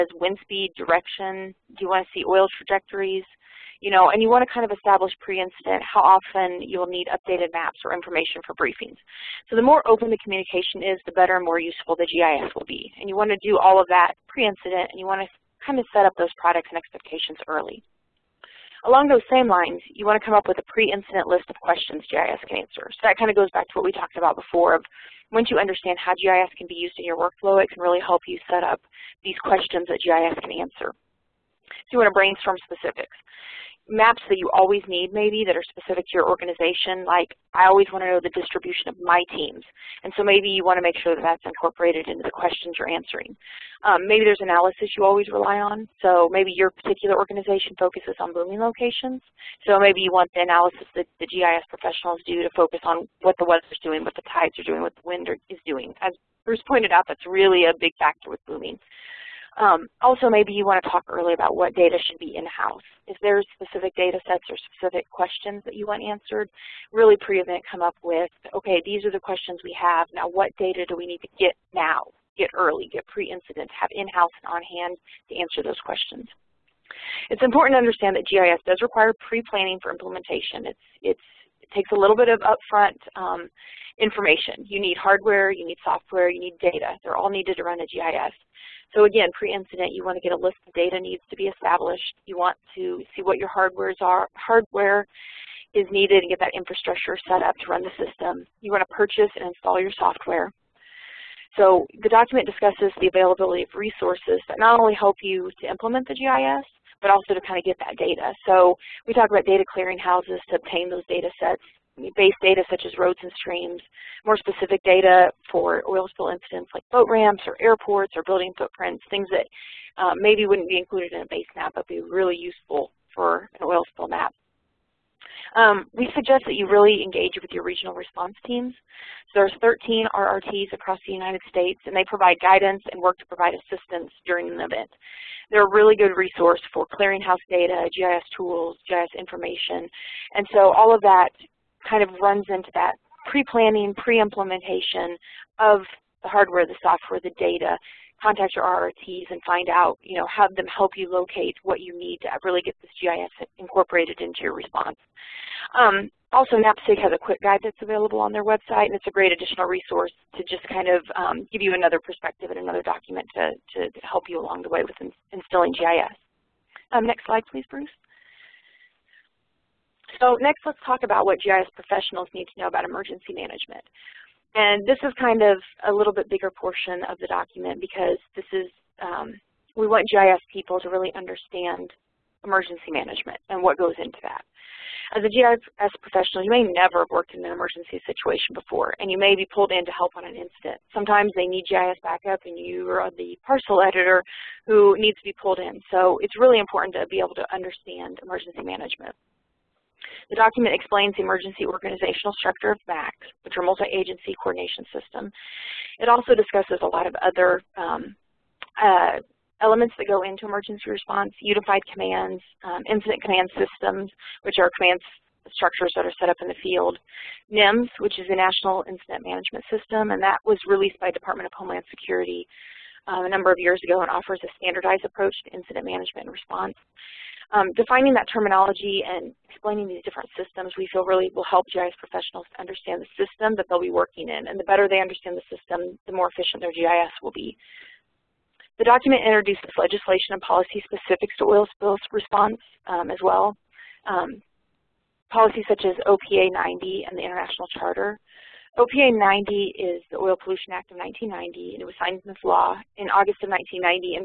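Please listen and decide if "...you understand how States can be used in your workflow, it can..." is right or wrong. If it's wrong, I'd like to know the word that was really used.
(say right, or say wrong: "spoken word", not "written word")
wrong: "GIS", not "States".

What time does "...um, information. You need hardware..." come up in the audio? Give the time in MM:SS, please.
01:23.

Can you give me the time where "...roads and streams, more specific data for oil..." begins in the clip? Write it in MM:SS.
01:52.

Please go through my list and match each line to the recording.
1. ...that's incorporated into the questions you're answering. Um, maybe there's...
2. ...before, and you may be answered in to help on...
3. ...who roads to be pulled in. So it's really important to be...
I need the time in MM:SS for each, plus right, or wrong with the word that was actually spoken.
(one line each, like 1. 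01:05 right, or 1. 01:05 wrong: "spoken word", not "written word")
1. 00:41 right
2. 03:08 wrong: "pulled", not "answered"
3. 03:14 wrong: "needs", not "roads".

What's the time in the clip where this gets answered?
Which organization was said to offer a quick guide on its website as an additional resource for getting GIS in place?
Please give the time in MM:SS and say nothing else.
02:36.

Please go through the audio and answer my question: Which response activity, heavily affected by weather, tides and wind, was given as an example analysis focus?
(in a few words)
Booming locations.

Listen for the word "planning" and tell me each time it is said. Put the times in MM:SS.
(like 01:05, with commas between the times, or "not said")
01:19, 02:23.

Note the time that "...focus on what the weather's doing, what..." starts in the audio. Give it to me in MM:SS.
00:52.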